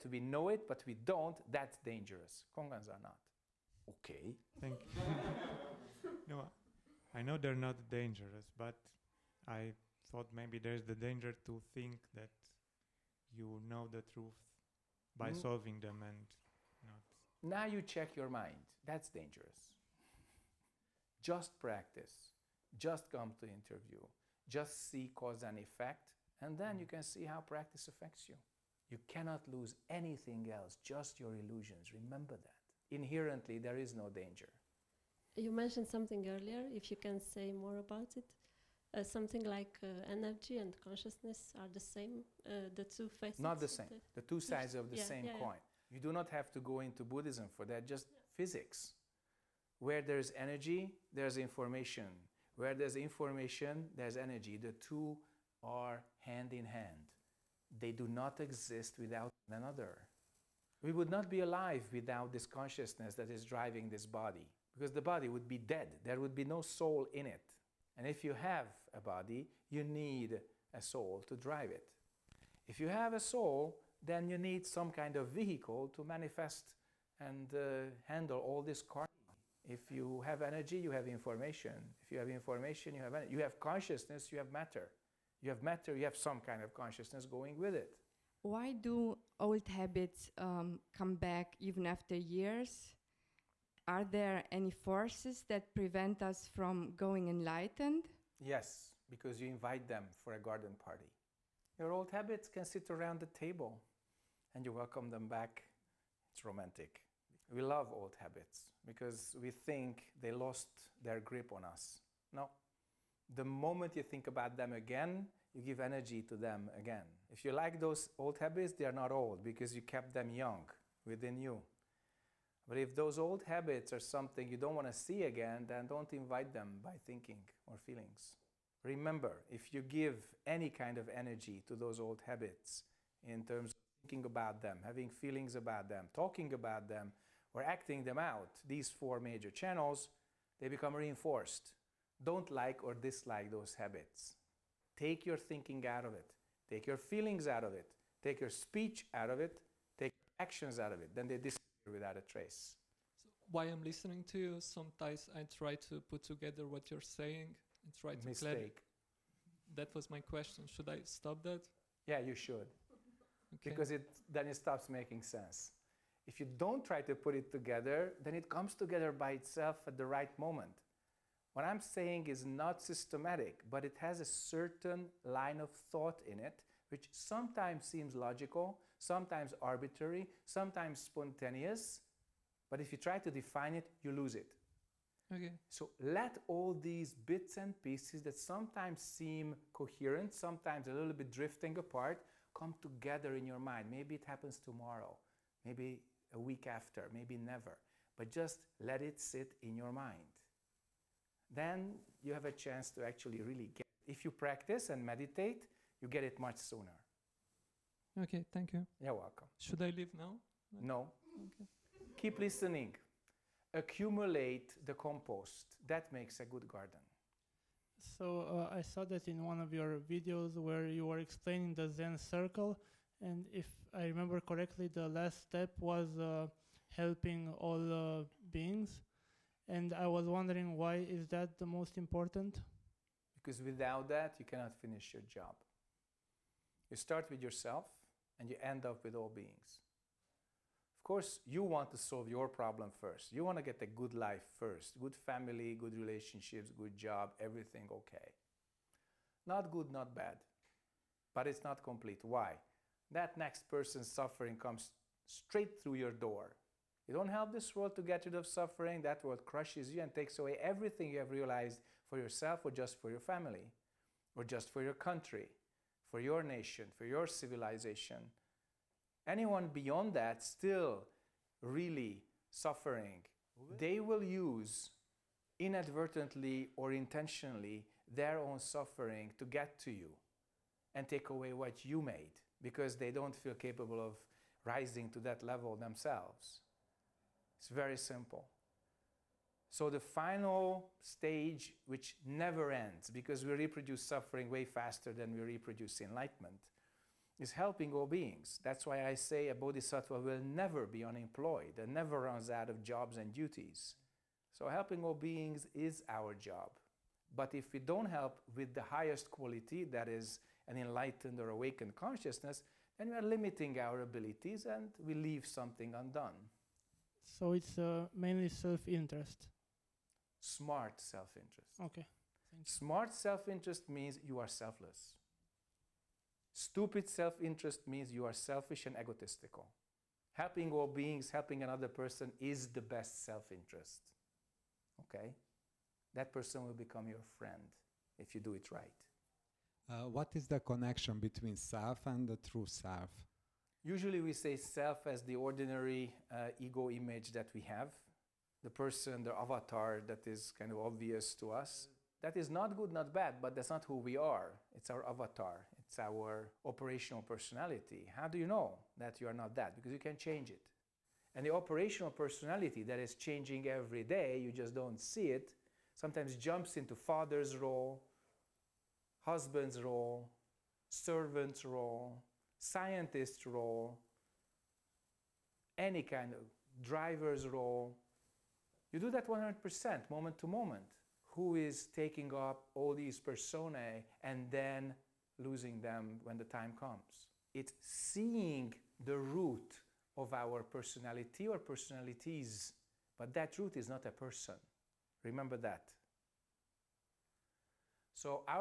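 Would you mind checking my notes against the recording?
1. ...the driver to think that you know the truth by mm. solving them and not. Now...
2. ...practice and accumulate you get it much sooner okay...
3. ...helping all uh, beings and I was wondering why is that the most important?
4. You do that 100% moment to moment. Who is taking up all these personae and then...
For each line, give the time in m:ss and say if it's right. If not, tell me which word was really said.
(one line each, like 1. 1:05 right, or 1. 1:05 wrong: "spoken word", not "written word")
1. 0:10 wrong: "danger", not "driver"
2. 3:24 wrong: "meditate", not "accumulate"
3. 3:46 right
4. 6:18 right.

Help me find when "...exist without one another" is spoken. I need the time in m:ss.
0:58.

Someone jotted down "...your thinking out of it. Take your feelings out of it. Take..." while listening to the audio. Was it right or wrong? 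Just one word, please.
right.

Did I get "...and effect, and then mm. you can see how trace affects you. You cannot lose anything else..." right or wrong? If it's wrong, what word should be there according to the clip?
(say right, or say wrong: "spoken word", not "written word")
wrong: "practice", not "trace".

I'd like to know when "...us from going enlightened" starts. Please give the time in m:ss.
1:36.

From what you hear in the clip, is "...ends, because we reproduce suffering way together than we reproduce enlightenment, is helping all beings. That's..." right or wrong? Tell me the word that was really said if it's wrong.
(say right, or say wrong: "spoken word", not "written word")
wrong: "faster", not "together".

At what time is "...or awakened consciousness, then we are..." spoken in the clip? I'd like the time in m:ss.
5:11.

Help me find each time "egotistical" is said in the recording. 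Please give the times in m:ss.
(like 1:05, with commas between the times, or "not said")
5:28.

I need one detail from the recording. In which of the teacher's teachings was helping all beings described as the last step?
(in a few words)
the Zen circle.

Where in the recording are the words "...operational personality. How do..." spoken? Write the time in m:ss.
5:56.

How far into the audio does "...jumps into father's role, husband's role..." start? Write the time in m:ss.
6:06.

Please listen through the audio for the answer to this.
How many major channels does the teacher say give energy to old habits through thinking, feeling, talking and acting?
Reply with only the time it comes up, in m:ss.
2:18.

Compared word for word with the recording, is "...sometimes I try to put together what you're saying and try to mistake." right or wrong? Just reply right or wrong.
right.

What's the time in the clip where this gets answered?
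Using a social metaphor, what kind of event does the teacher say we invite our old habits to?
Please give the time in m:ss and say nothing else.
1:40.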